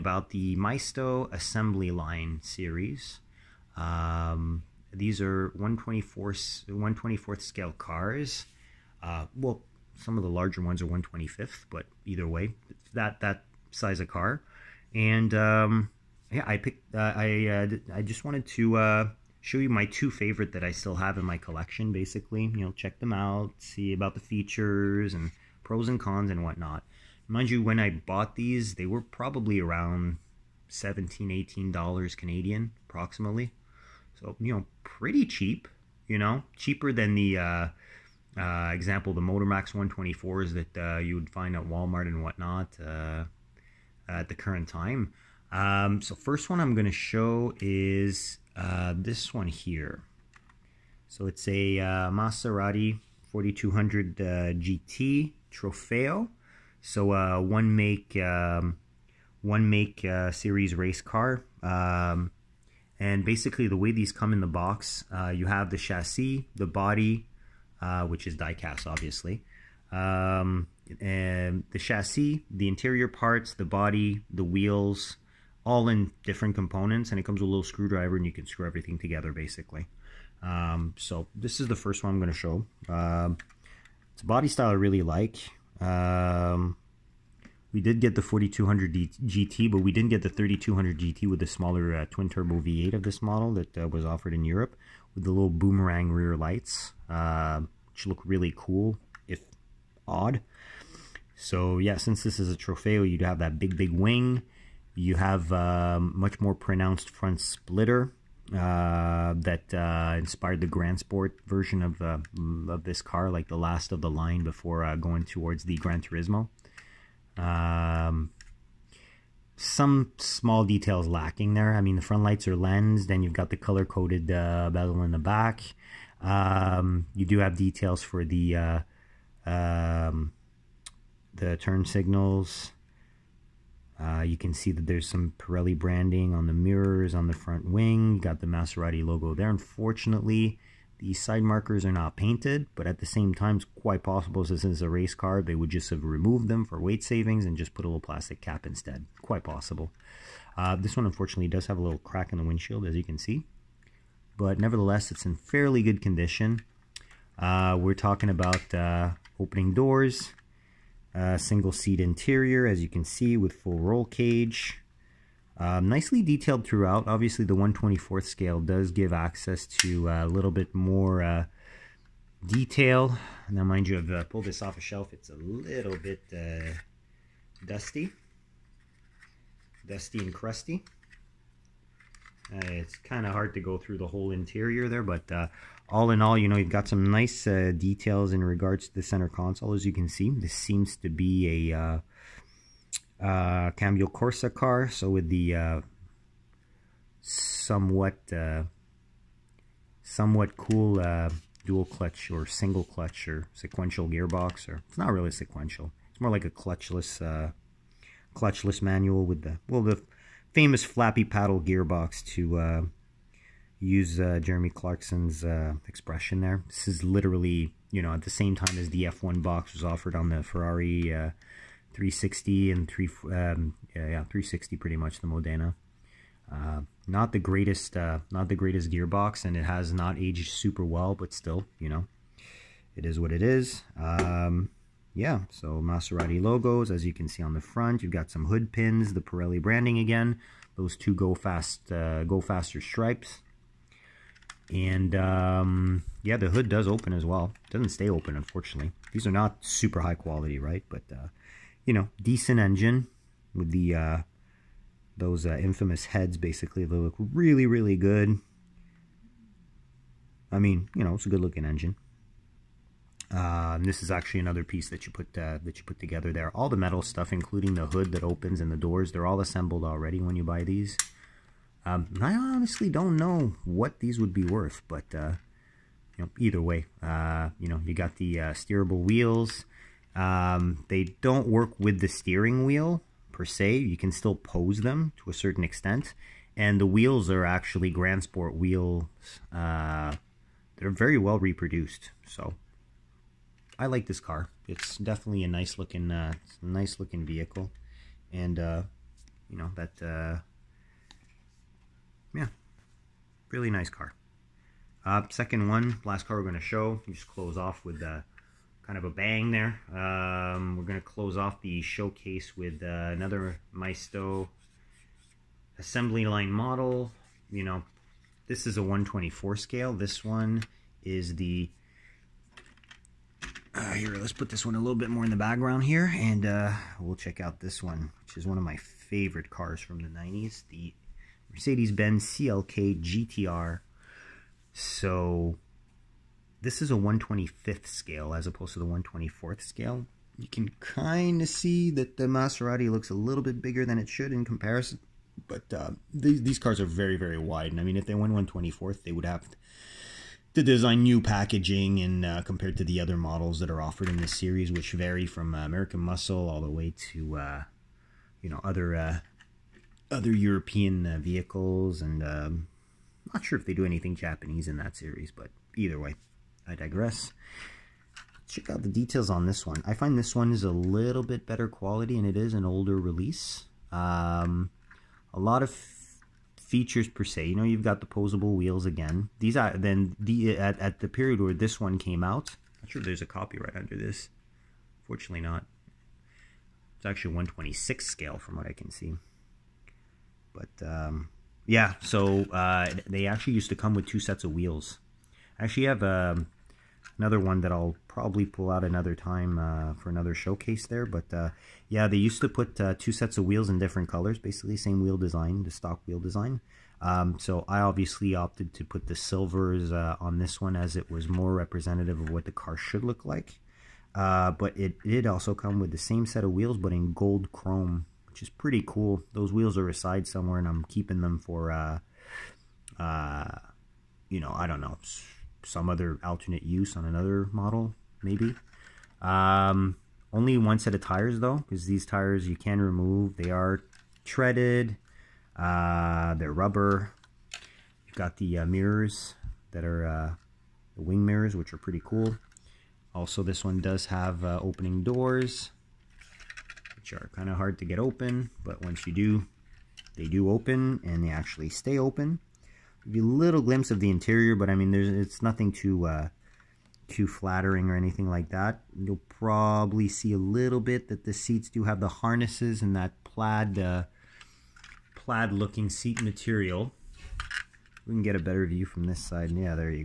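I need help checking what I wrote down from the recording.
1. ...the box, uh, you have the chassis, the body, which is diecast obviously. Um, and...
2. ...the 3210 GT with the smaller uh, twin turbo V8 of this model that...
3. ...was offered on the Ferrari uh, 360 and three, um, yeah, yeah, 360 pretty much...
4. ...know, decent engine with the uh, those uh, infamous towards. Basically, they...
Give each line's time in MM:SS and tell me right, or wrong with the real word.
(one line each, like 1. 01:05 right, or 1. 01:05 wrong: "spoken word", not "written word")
1. 01:04 right
2. 01:30 wrong: "3200", not "3210"
3. 03:39 right
4. 04:11 wrong: "heads", not "towards".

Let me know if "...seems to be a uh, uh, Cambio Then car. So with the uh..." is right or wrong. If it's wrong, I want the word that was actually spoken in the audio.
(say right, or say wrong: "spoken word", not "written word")
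wrong: "Corsa", not "Then".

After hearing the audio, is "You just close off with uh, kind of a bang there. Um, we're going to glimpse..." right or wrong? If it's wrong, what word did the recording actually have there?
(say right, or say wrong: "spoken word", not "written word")
wrong: "close", not "glimpse".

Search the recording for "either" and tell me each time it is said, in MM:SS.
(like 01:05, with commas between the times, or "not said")
00:12, 04:36, 06:05.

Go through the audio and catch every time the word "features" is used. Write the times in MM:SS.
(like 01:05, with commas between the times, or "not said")
00:24, 06:16.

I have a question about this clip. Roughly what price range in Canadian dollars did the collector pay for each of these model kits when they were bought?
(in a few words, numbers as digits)
17-18 dollars.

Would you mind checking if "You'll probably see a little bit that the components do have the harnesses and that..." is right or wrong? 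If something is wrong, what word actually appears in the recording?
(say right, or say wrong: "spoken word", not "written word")
wrong: "seats", not "components".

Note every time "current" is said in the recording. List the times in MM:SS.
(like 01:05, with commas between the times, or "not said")
00:44.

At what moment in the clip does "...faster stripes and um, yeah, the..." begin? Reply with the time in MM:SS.
04:02.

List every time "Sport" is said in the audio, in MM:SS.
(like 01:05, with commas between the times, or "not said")
01:50, 04:48.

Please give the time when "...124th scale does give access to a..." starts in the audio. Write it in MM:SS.
02:47.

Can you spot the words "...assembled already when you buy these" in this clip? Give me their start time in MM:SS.
04:29.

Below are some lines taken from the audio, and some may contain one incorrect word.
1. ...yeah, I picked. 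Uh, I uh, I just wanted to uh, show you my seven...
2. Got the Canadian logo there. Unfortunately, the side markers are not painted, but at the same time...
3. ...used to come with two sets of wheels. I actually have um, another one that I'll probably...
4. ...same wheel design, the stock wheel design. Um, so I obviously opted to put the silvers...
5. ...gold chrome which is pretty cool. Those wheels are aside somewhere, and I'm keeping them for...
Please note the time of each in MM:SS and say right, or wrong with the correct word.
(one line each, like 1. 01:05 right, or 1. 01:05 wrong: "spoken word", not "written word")
1. 00:16 wrong: "two", not "seven"
2. 02:18 wrong: "Maserati", not "Canadian"
3. 06:33 right
4. 06:44 right
5. 06:57 right.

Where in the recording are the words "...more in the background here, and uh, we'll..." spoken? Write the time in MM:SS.
05:25.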